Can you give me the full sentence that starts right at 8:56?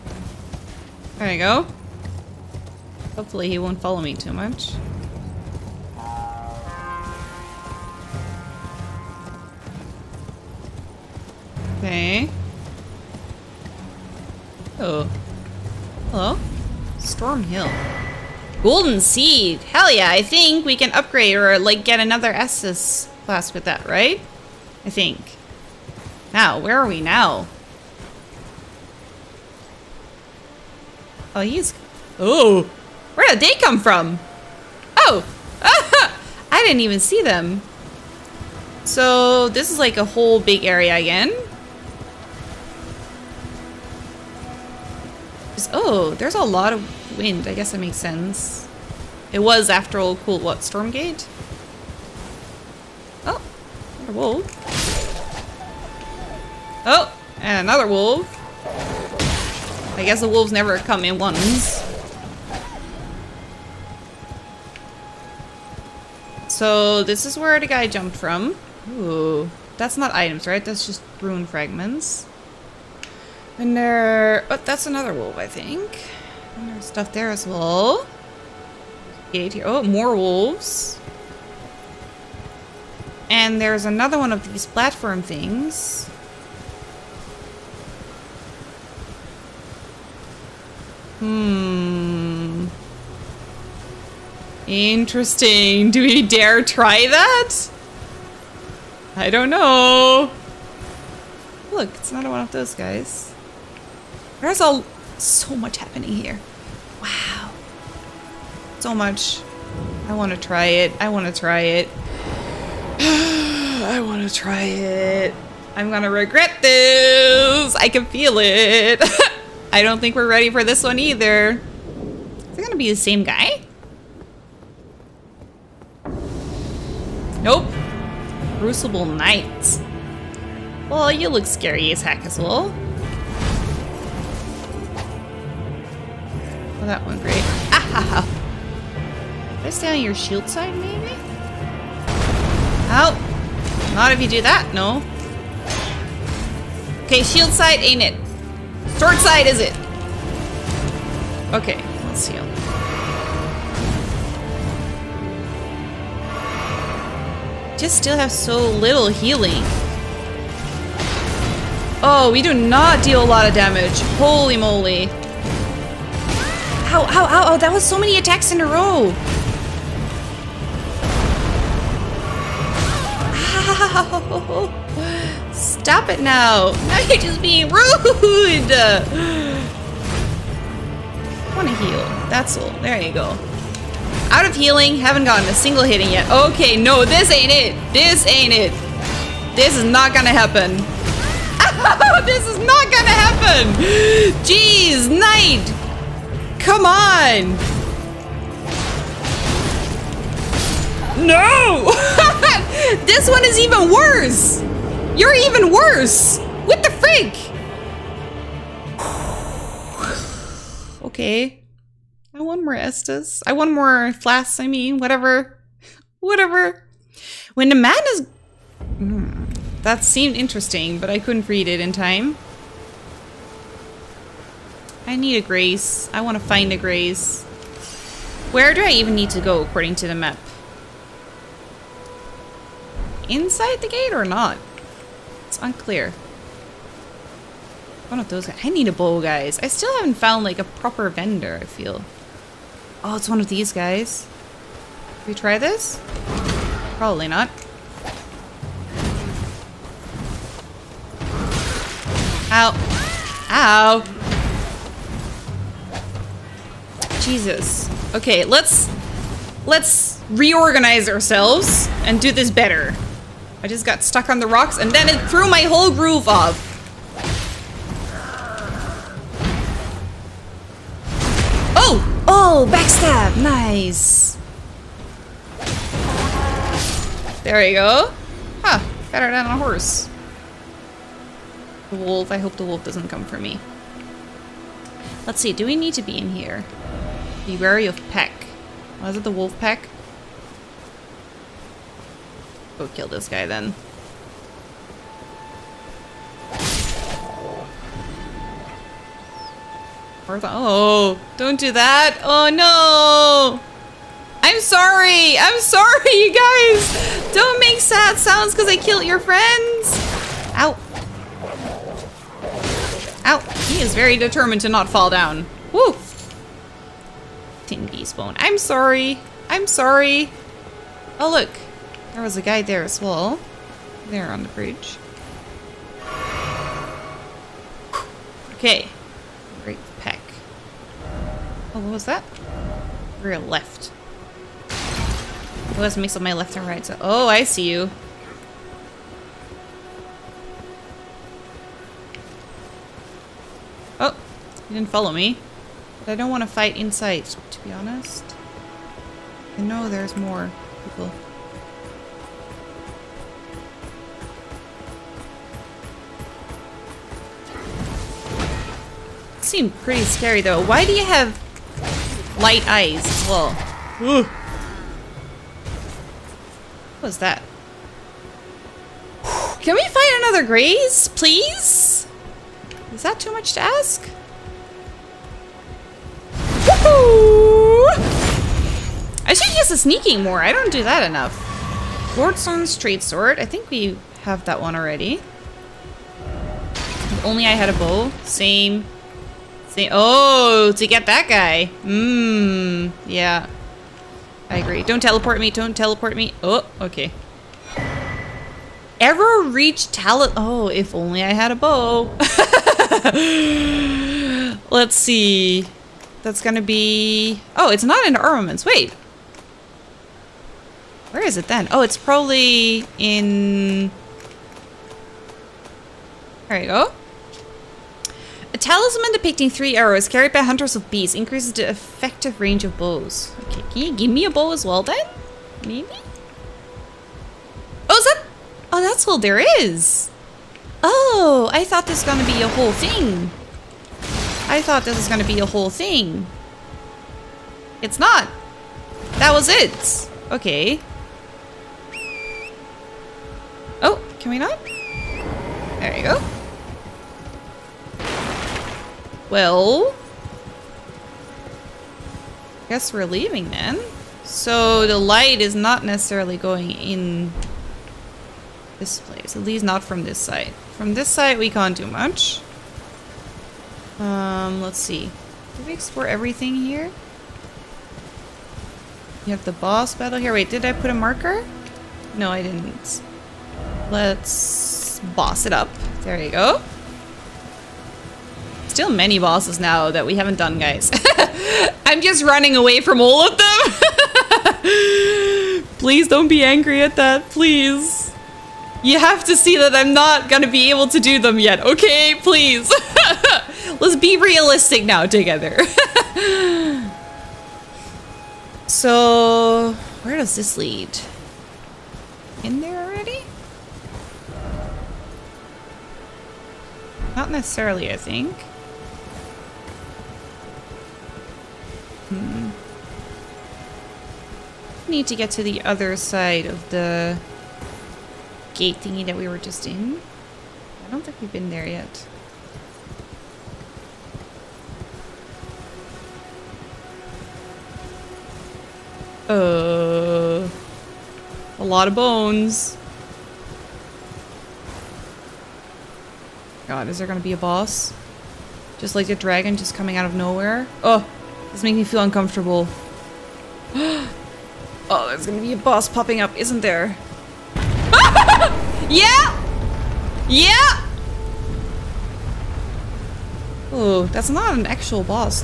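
god, is there gonna be a boss?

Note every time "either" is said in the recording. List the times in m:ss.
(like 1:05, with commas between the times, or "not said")
2:00.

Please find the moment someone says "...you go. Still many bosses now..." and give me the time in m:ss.
7:56.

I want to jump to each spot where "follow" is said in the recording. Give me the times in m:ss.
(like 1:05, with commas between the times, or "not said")
0:03, 5:44.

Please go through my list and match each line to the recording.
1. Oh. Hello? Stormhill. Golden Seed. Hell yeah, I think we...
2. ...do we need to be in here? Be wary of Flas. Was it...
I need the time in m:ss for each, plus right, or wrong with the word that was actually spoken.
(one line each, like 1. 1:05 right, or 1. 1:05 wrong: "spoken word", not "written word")
1. 0:14 right
2. 4:45 wrong: "Peck", not "Flas".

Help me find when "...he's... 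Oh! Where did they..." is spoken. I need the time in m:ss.
0:31.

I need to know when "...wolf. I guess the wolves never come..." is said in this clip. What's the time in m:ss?
0:57.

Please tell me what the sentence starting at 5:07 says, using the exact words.
Don't make sad sounds because I killed your friends.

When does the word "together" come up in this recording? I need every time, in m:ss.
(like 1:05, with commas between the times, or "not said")
8:15.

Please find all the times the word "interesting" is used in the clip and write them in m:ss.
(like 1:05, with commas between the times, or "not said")
1:34, 3:40.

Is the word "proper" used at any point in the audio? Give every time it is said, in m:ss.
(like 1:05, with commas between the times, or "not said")
4:00.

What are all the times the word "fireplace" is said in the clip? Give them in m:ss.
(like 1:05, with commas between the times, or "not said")
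not said.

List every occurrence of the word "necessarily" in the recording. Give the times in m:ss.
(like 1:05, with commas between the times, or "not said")
7:35, 8:27.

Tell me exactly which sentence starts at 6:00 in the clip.
Why do you have light eyes as well?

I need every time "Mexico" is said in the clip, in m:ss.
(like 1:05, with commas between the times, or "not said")
not said.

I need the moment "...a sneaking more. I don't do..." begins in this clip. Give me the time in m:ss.
6:19.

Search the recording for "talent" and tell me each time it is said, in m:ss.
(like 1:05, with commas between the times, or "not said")
6:39.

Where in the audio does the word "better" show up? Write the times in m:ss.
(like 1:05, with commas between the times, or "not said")
4:22, 4:39.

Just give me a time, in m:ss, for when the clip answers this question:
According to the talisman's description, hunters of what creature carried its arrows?
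7:00.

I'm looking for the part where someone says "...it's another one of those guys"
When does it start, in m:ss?
1:41.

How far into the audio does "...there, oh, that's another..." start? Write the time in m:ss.
1:13.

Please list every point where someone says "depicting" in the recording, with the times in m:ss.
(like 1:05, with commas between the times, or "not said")
6:59.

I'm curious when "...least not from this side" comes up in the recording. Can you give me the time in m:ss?
7:39.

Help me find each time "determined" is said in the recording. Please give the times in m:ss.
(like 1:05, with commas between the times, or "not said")
5:14.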